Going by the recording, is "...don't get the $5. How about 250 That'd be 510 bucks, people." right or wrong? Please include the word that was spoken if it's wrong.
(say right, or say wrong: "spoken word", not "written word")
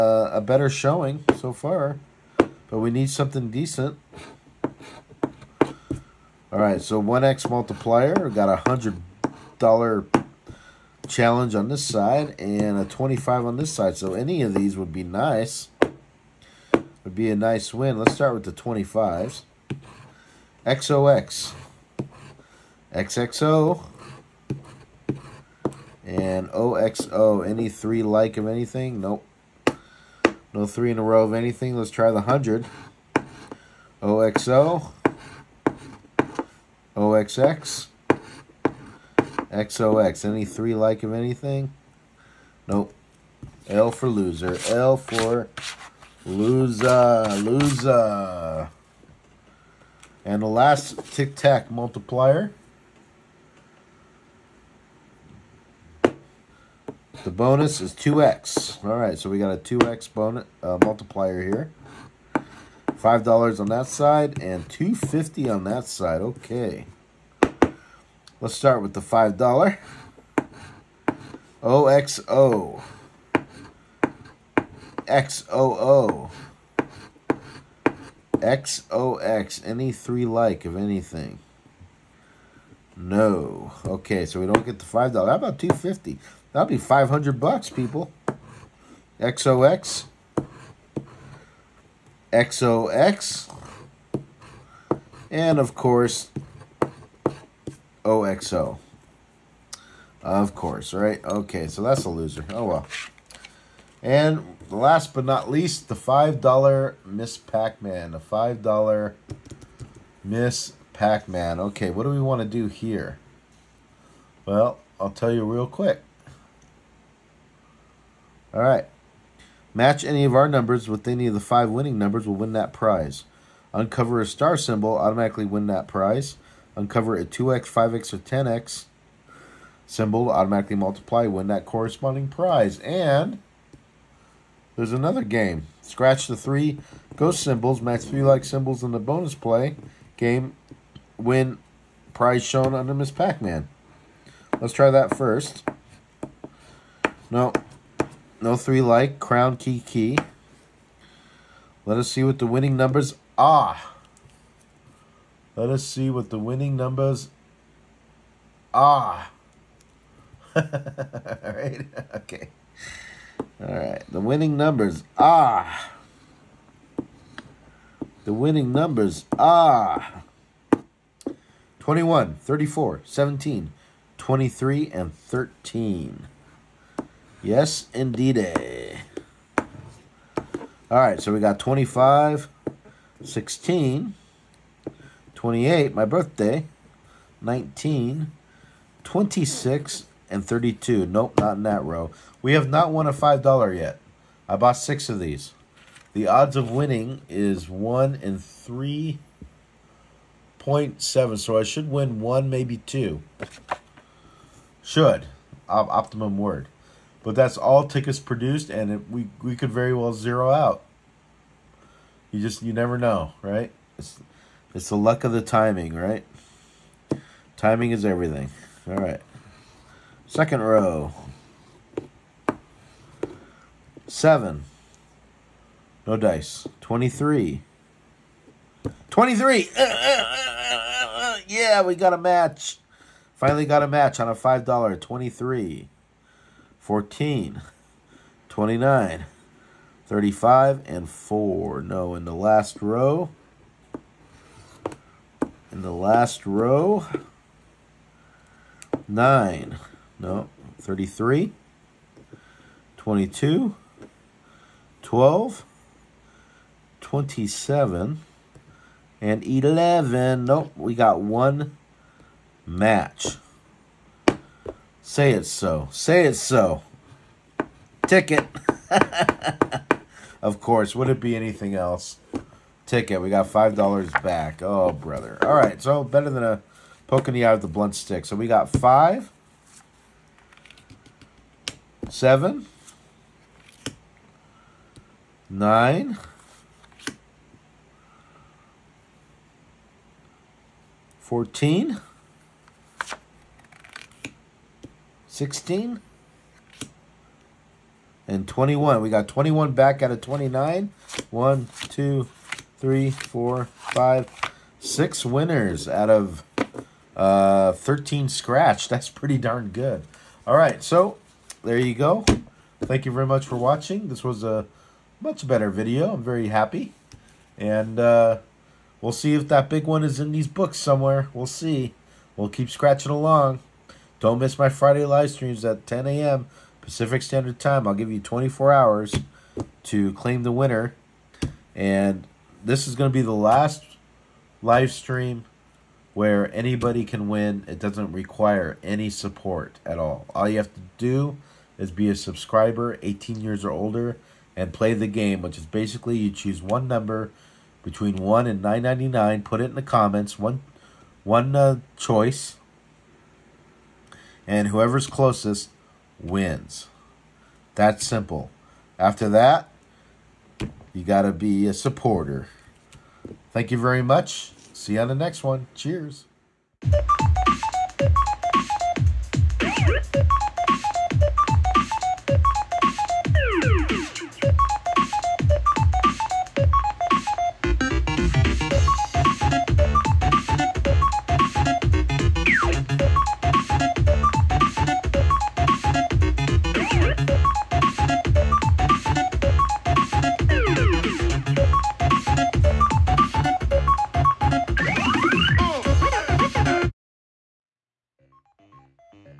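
wrong: "500", not "510".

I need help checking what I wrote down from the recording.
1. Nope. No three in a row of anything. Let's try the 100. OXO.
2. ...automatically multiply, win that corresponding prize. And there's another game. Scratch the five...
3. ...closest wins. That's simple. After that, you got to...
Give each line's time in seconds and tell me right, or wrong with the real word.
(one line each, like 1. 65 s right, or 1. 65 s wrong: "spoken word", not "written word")
1. 28 s right
2. 130 s wrong: "three", not "five"
3. 355 s right.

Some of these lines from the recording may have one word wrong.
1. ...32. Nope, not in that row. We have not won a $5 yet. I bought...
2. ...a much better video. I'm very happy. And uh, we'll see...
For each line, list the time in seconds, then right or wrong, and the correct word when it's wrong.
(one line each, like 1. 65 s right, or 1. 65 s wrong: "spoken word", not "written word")
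1. 190 s right
2. 314 s right.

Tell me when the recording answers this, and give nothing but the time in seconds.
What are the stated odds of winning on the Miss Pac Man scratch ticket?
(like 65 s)
197 s.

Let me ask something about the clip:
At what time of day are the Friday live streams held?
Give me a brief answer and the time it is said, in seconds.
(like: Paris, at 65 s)
10 a.m. Pacific, at 325 s.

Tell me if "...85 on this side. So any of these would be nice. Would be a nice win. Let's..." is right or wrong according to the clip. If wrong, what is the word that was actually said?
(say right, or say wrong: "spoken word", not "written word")
wrong: "25", not "85".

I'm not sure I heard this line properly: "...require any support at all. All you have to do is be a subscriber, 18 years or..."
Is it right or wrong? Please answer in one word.
right.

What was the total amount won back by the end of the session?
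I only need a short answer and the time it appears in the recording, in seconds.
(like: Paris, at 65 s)
$21, at 299 s.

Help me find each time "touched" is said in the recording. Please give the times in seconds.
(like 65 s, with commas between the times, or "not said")
not said.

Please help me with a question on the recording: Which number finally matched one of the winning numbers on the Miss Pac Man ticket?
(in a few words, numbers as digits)
23.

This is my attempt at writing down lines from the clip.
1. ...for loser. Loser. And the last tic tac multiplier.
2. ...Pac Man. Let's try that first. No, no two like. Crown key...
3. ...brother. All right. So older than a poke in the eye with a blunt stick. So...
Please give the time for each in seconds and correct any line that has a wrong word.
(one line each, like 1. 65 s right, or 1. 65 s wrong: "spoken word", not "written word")
1. 44 s right
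2. 143 s wrong: "three", not "two"
3. 274 s wrong: "better", not "older".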